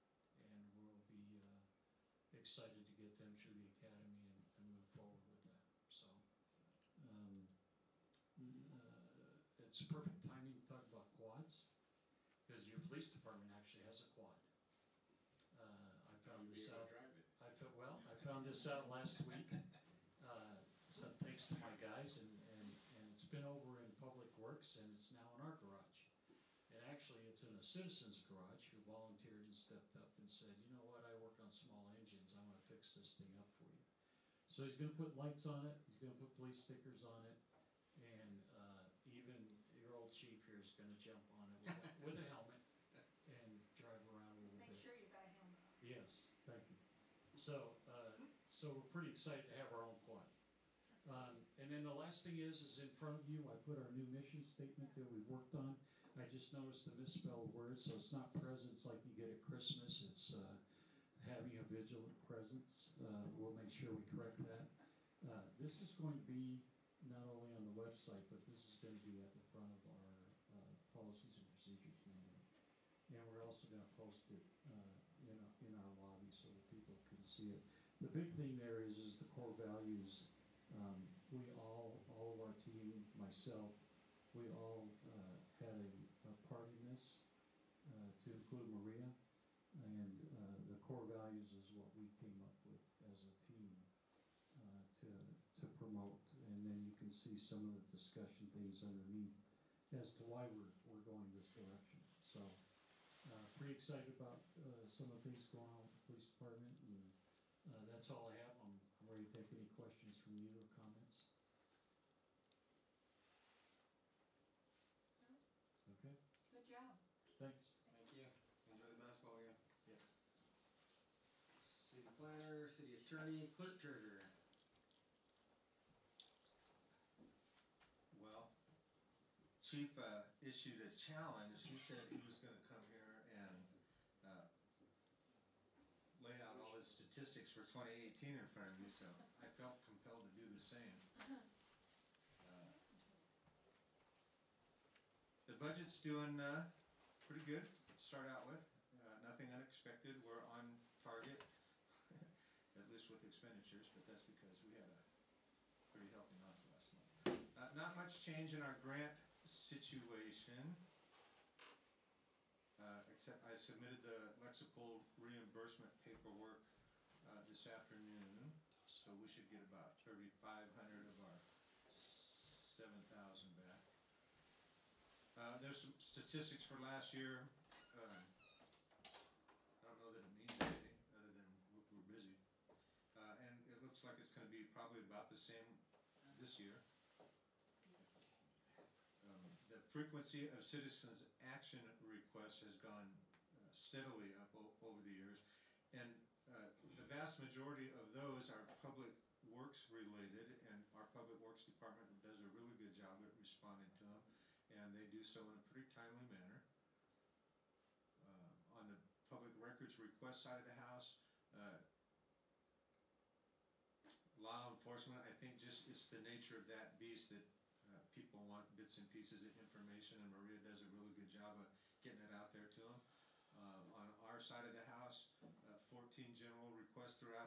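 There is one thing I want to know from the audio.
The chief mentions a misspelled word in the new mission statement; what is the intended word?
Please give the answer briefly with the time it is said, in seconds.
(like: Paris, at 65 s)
presence, at 62 s.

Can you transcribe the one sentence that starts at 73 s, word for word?
And we're also going to post it uh, in, a, in our lobby so that people can see it.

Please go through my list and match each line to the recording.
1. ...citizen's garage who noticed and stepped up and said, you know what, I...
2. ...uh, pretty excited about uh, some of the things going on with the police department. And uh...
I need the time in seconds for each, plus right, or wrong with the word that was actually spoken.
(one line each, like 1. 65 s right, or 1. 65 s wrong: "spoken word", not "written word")
1. 27 s wrong: "volunteered", not "noticed"
2. 103 s right.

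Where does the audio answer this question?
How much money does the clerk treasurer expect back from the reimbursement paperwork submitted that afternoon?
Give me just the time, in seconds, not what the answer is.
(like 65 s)
170 s.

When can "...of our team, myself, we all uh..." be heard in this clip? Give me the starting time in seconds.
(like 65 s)
82 s.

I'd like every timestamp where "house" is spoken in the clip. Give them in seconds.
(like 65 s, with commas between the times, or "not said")
210 s, 224 s.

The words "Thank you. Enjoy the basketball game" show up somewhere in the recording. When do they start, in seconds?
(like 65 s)
117 s.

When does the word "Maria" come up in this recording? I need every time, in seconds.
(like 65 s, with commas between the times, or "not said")
88 s, 220 s.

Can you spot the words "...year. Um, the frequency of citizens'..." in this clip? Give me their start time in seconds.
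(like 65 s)
186 s.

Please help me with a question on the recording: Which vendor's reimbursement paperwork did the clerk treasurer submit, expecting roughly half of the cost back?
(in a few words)
Lexipol.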